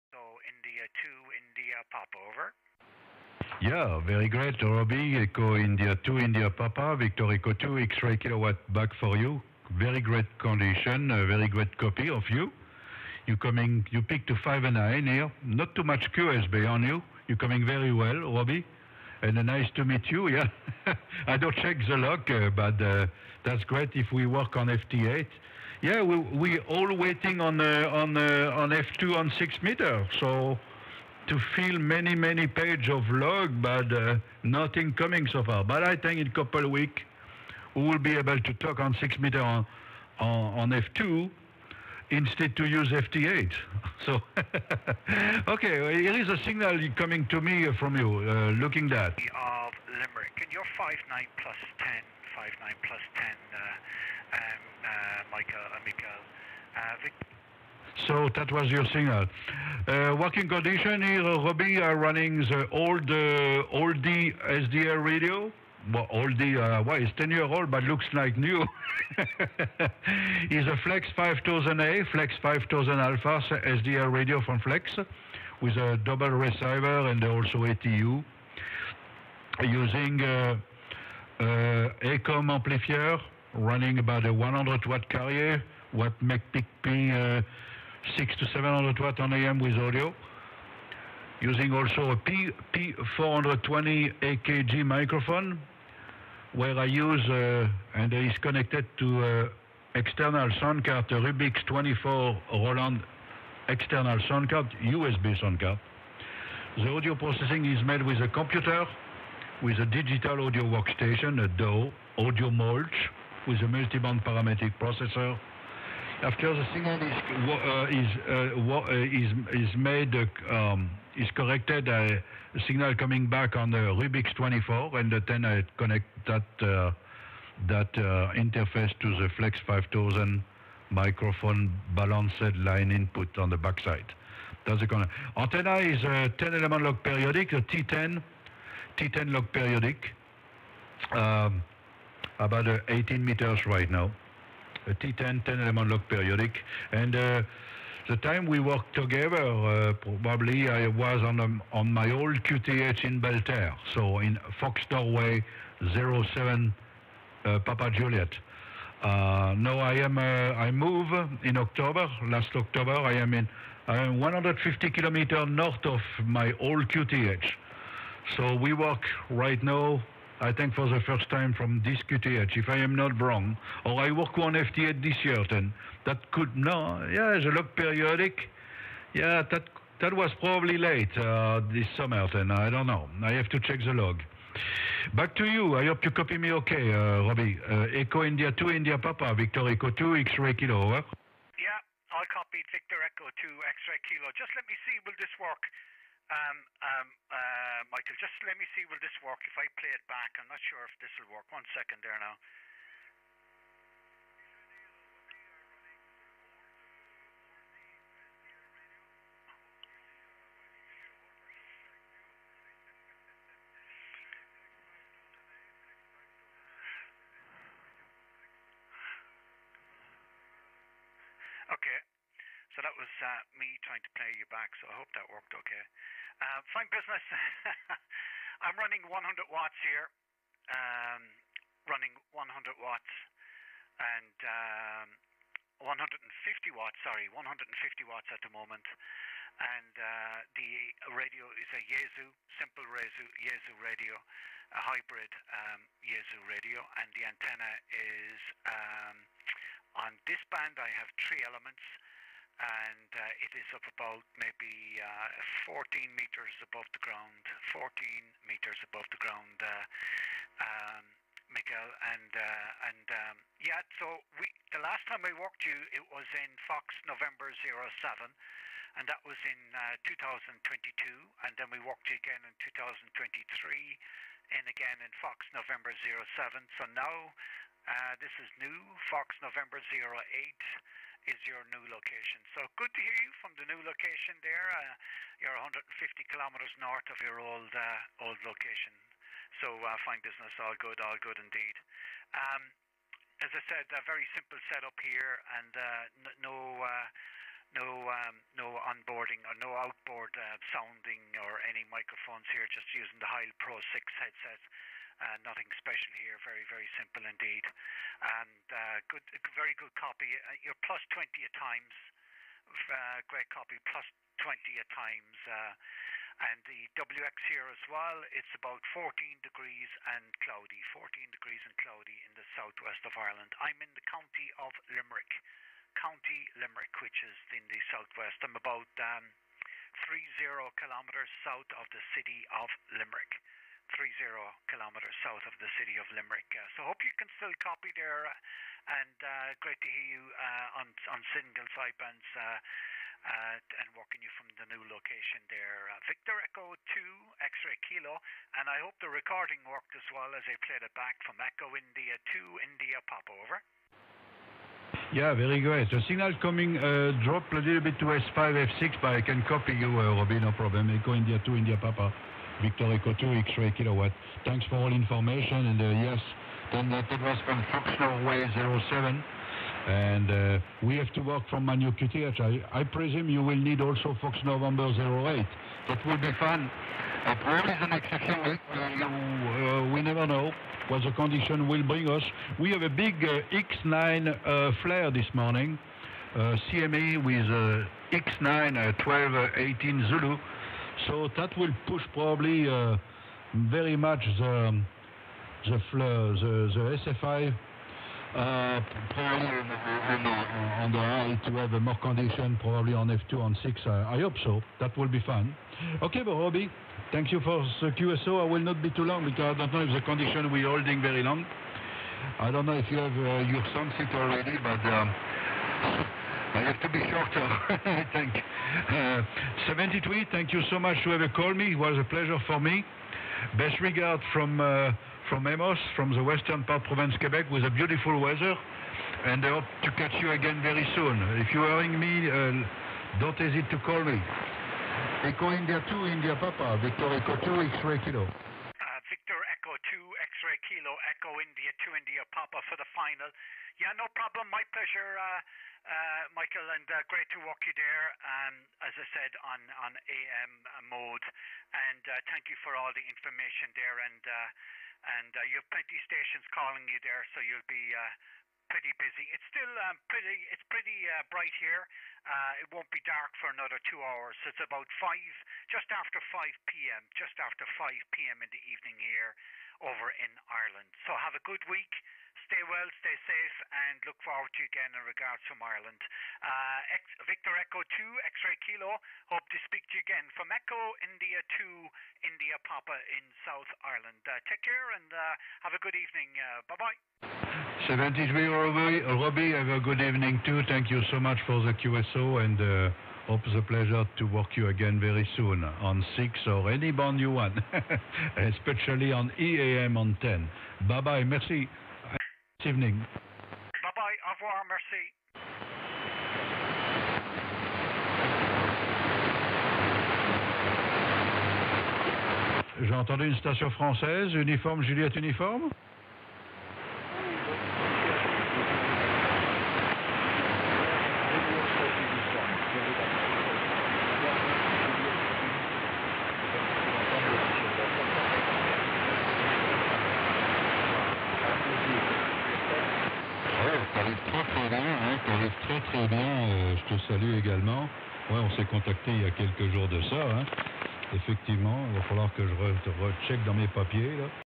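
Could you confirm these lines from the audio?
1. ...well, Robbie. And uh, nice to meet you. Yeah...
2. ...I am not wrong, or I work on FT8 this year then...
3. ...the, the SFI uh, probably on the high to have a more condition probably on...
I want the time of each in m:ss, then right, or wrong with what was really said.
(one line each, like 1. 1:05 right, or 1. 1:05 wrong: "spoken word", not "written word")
1. 0:17 right
2. 2:52 right
3. 6:35 right.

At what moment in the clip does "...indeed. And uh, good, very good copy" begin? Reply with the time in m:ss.
5:07.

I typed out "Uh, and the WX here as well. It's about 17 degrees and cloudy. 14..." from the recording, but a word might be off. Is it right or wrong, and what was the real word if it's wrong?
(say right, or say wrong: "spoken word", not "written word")
wrong: "14", not "17".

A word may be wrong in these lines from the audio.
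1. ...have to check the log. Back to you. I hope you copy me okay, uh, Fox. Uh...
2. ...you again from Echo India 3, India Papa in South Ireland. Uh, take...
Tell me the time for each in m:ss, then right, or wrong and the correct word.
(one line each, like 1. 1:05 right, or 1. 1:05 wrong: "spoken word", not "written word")
1. 3:03 wrong: "Robbie", not "Fox"
2. 7:59 wrong: "2", not "3".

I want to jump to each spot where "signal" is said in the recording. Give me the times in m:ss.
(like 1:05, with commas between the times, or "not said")
0:46, 0:58, 1:56, 2:02, 5:56.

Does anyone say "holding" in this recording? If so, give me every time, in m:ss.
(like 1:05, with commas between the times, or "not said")
6:50.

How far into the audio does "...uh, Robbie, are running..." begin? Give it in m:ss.
1:01.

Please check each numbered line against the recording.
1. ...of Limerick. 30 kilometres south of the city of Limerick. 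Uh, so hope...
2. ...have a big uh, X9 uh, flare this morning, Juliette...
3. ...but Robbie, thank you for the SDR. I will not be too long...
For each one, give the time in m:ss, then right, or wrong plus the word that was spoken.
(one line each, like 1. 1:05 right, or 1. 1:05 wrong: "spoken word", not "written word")
1. 5:32 right
2. 6:22 wrong: "CME", not "Juliette"
3. 6:46 wrong: "QSO", not "SDR".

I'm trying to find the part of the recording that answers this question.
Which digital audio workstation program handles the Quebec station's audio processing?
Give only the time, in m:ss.
1:52.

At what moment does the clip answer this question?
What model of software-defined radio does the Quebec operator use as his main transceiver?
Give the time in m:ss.
1:10.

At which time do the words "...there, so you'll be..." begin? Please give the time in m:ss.
7:37.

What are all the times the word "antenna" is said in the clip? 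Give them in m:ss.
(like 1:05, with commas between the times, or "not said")
2:15, 4:07.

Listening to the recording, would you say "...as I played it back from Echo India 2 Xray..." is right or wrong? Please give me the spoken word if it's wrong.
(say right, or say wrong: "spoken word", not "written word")
wrong: "India", not "Xray".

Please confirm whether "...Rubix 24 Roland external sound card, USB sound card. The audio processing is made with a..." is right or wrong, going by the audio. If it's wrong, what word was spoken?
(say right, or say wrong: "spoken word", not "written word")
right.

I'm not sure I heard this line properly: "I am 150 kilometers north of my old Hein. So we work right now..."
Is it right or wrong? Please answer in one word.
wrong.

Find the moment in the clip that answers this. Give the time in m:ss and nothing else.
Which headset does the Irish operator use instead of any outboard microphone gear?
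5:03.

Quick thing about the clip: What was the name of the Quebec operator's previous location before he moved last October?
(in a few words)
Belleterre.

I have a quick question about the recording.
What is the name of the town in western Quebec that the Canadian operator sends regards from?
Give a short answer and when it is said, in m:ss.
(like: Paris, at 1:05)
Amos, at 7:05.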